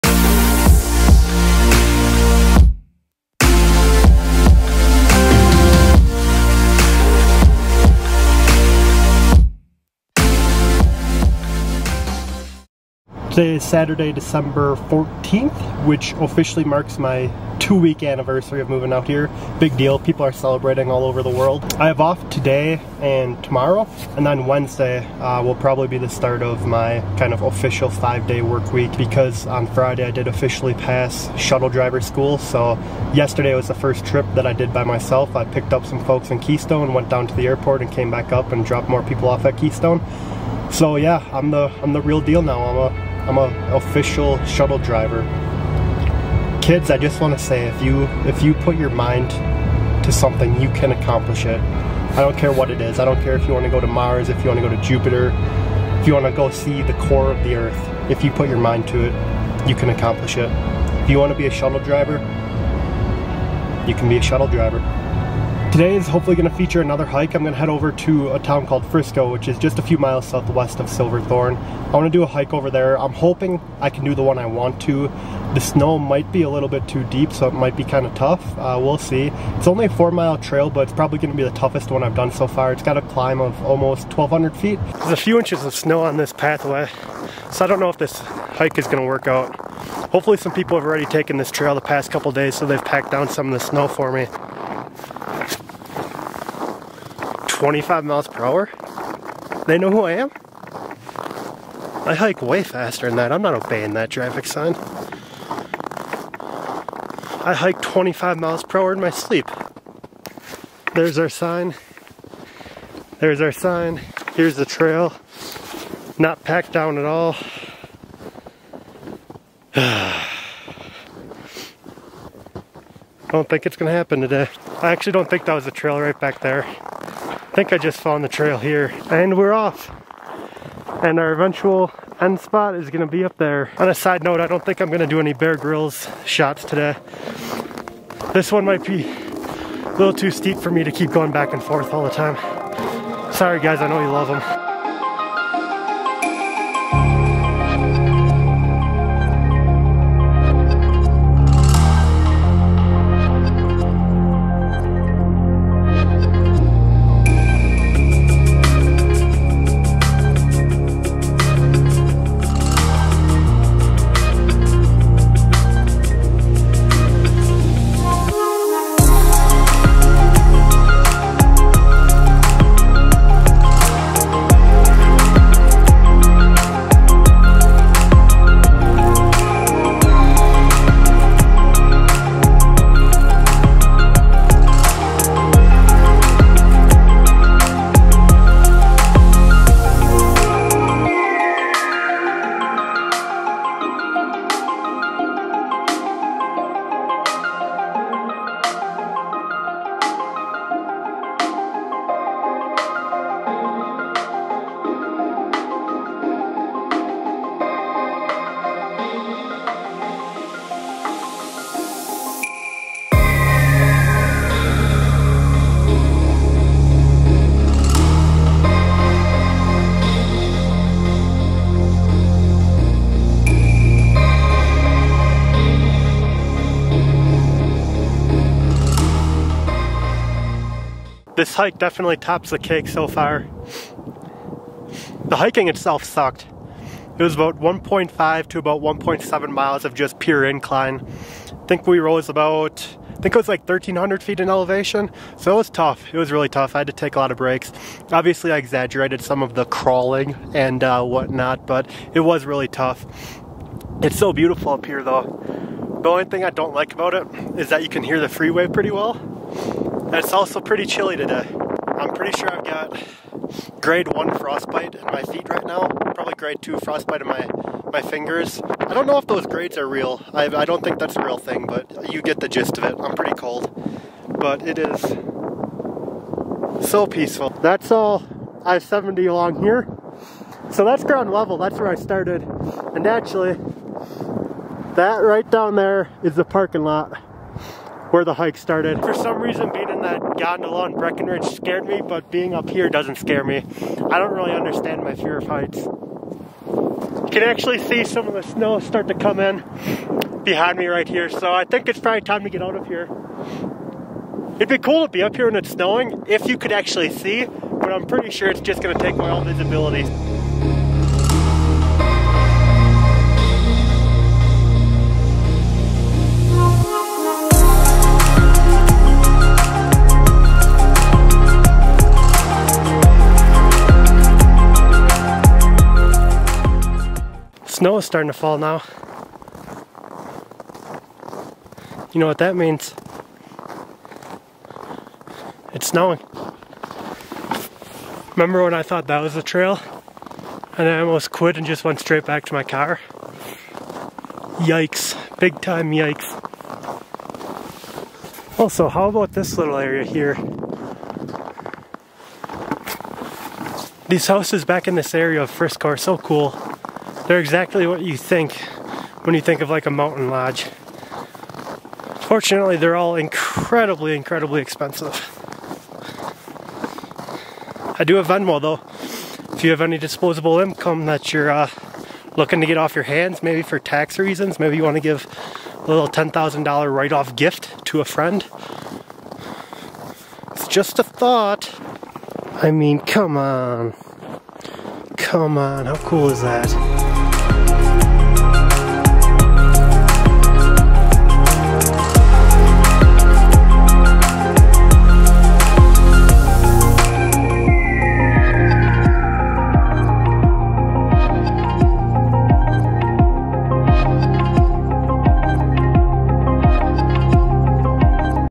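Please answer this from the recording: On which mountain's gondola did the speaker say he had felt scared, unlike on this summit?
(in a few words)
Breckenridge.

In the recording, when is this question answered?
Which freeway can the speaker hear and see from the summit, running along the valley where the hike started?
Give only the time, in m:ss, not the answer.
4:38.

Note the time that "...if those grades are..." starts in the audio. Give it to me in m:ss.
4:29.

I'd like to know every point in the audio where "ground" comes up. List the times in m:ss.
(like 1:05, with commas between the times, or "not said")
4:41.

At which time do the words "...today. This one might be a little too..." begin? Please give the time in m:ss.
2:16.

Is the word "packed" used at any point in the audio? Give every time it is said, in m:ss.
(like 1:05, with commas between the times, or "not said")
1:32, 1:56.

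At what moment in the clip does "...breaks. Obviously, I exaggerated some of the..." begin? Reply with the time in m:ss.
4:07.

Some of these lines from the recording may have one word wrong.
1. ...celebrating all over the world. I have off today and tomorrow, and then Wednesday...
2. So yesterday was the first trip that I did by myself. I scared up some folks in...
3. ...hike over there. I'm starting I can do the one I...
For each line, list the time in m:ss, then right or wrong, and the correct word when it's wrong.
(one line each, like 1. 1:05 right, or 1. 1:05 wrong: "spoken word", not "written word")
1. 0:20 right
2. 0:32 wrong: "picked", not "scared"
3. 1:12 wrong: "hoping", not "starting".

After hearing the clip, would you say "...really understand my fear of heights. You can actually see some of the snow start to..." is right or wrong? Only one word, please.
right.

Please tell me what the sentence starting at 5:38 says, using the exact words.
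Remember when I thought that was the trail?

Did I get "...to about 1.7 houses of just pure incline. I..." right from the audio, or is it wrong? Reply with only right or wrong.
wrong.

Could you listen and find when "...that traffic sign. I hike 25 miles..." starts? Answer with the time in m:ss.
1:43.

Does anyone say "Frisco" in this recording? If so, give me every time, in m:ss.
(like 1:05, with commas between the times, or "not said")
1:08, 5:55.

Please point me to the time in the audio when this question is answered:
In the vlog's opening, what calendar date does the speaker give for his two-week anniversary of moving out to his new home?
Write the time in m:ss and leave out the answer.
0:14.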